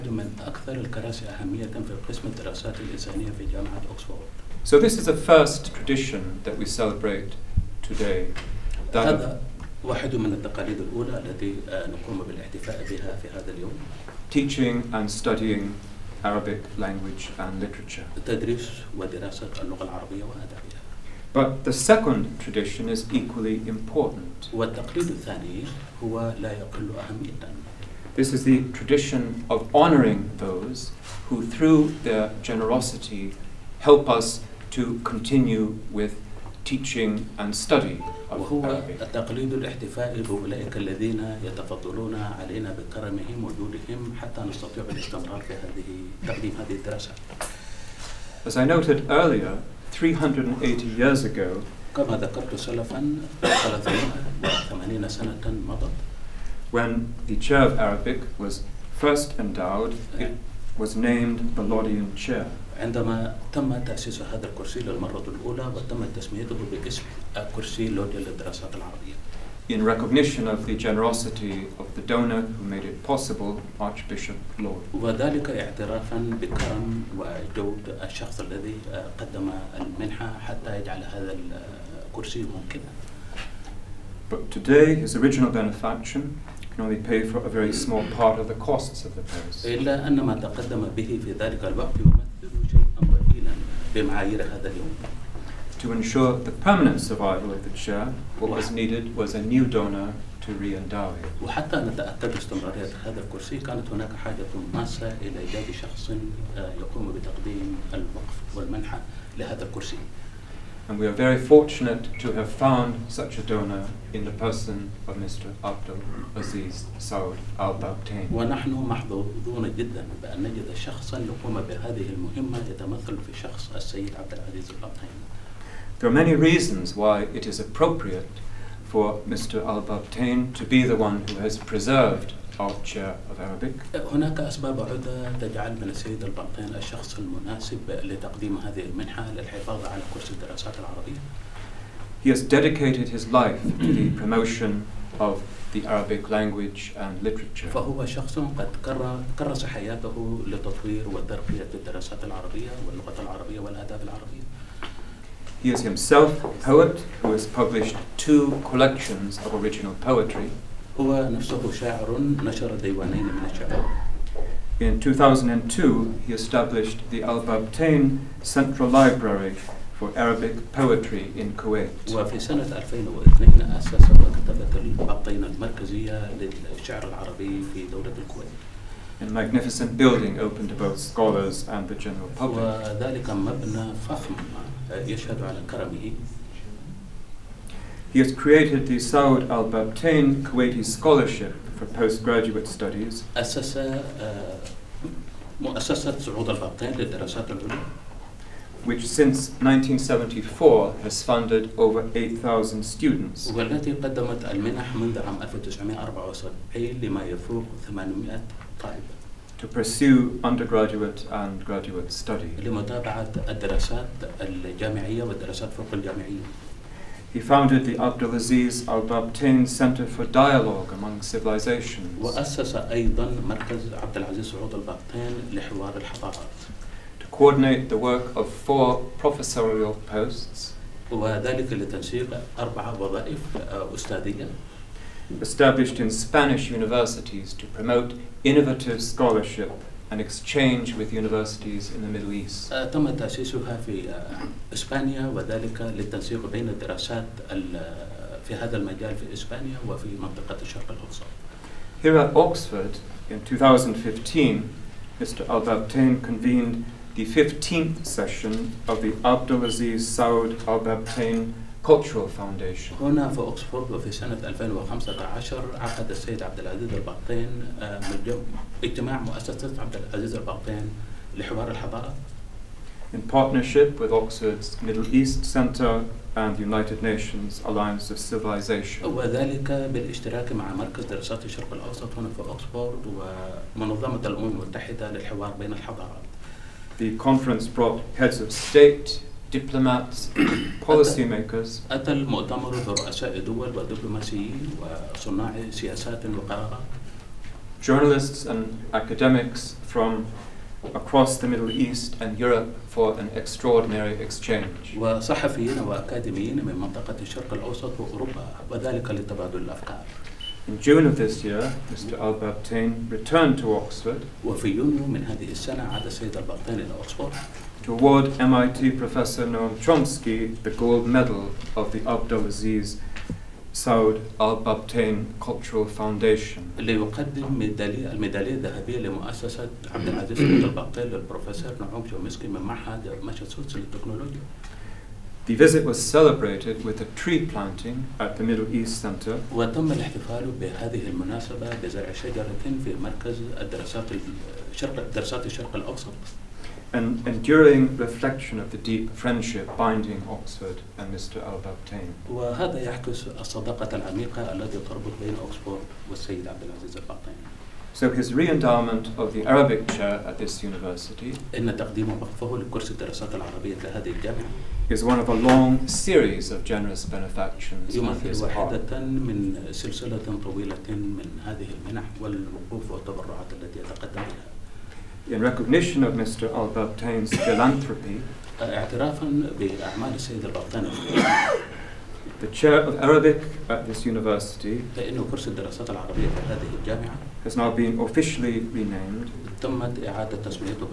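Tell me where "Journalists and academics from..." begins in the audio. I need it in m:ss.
4:57.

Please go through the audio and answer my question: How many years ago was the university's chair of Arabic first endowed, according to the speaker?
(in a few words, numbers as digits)
380.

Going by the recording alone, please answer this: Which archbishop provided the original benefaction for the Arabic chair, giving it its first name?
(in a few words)
Archbishop Laud.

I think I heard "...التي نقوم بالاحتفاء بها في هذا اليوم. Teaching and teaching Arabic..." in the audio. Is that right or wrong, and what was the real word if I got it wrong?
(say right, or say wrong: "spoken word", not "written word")
wrong: "studying", not "teaching".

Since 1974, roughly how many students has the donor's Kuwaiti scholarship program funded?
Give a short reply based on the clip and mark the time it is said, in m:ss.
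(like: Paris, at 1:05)
over 8,000, at 3:21.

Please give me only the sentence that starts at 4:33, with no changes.
In partnership with Oxford's Middle East Center and the United Nations Alliance of Civilization.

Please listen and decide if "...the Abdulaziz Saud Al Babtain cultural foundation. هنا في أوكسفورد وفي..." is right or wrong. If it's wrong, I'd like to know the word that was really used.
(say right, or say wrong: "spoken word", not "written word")
right.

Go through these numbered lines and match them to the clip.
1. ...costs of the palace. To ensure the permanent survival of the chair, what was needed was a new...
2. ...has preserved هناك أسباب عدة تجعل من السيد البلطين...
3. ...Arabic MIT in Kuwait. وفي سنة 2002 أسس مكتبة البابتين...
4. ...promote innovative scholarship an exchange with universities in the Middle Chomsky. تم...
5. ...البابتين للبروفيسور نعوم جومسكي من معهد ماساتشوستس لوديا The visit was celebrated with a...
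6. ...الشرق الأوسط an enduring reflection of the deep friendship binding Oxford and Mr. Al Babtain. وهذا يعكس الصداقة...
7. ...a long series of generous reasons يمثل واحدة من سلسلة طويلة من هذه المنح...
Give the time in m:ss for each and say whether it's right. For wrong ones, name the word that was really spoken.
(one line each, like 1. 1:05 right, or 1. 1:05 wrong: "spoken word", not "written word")
1. 1:28 right
2. 2:11 right
3. 2:50 wrong: "Poetry", not "MIT"
4. 3:57 wrong: "East", not "Chomsky"
5. 5:30 wrong: "للتكنولوجيا", not "لوديا"
6. 5:45 right
7. 6:05 wrong: "benefactions", not "reasons".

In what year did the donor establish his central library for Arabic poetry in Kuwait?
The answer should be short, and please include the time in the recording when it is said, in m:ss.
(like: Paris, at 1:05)
2002, at 2:44.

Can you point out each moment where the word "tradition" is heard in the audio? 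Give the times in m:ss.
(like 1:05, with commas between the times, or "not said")
0:05, 0:22, 0:28.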